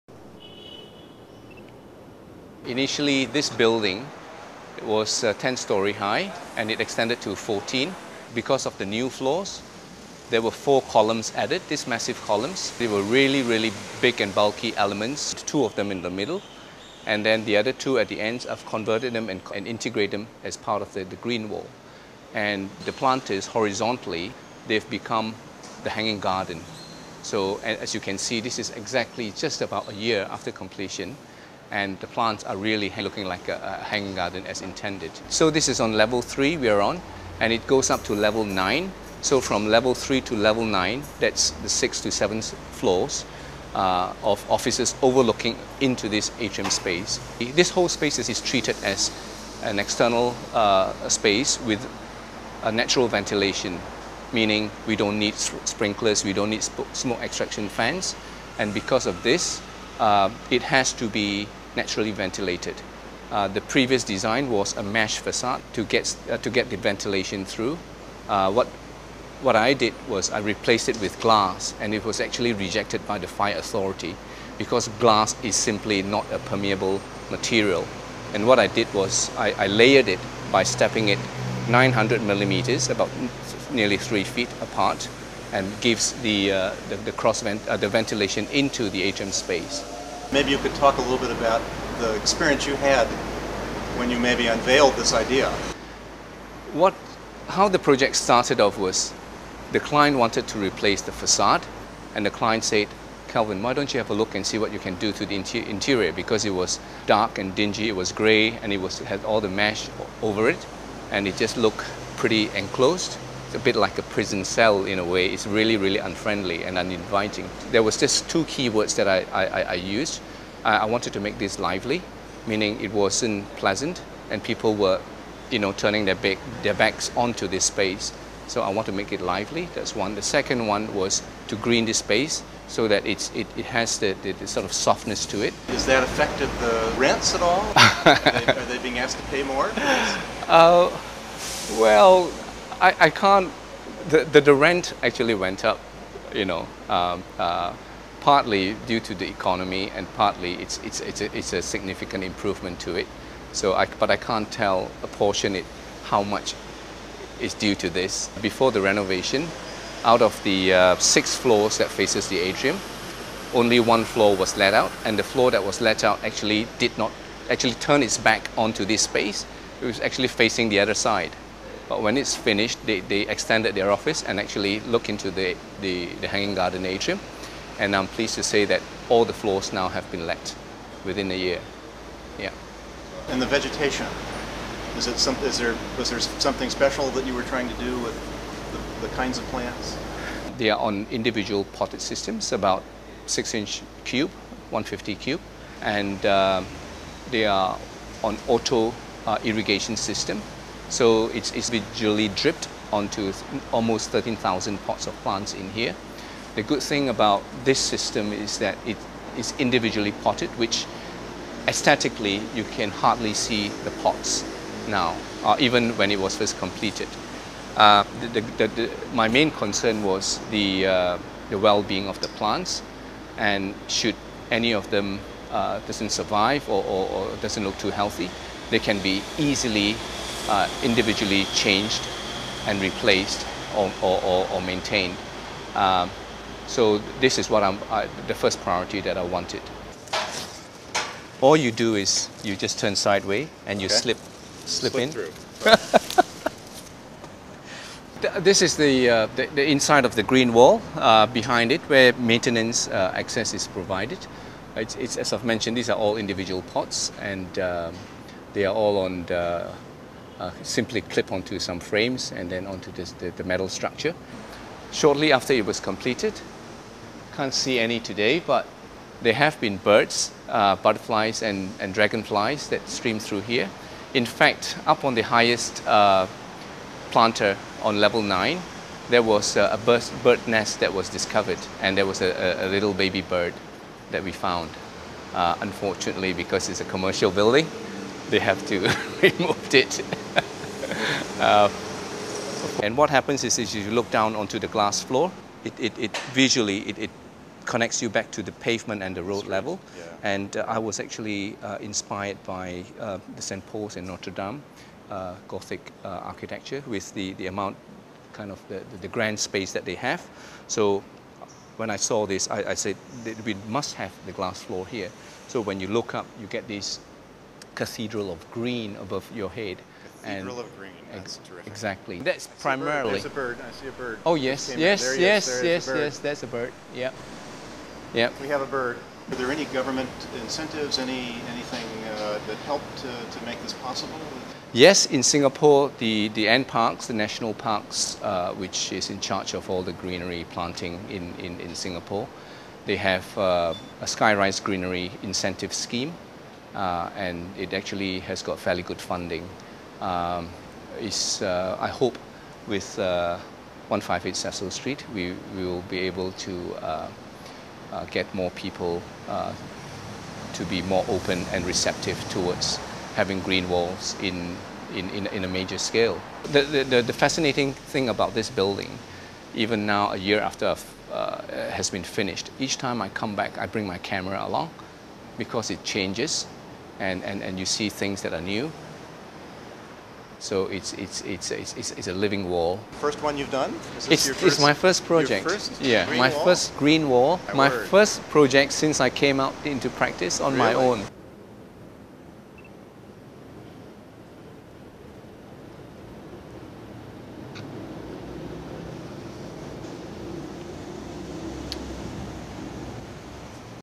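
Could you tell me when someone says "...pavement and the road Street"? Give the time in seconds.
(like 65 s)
298 s.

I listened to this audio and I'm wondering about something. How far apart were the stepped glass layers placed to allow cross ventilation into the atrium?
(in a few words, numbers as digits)
900 millimeters.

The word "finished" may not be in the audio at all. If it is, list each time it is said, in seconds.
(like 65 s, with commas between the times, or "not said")
172 s, 372 s.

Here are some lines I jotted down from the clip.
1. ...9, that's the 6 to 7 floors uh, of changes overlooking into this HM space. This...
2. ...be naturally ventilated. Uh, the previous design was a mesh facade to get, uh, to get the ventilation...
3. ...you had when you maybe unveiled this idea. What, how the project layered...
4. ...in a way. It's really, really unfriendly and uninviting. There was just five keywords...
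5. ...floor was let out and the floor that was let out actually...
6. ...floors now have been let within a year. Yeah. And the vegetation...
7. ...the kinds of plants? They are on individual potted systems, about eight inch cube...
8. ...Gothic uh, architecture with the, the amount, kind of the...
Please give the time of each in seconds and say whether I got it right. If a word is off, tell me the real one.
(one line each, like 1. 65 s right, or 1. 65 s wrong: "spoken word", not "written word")
1. 40 s wrong: "offices", not "changes"
2. 61 s right
3. 92 s wrong: "started", not "layered"
4. 114 s wrong: "two", not "five"
5. 164 s right
6. 179 s right
7. 189 s wrong: "six", not "eight"
8. 305 s right.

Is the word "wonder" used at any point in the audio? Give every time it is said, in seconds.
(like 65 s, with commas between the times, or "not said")
not said.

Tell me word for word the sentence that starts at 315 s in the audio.
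So when you look up, you get this cathedral of green above your head and of green.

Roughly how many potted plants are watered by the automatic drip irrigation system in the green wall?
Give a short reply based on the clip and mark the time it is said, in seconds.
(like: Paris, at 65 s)
13,000, at 204 s.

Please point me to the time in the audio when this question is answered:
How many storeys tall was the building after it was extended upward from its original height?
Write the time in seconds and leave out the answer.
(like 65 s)
7 s.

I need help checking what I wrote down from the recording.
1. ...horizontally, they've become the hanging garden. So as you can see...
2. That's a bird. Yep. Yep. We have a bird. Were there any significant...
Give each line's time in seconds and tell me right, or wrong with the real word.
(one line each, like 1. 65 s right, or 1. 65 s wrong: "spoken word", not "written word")
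1. 23 s right
2. 326 s wrong: "government", not "significant".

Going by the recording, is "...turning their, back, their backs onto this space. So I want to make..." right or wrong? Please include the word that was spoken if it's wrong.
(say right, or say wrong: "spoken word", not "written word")
right.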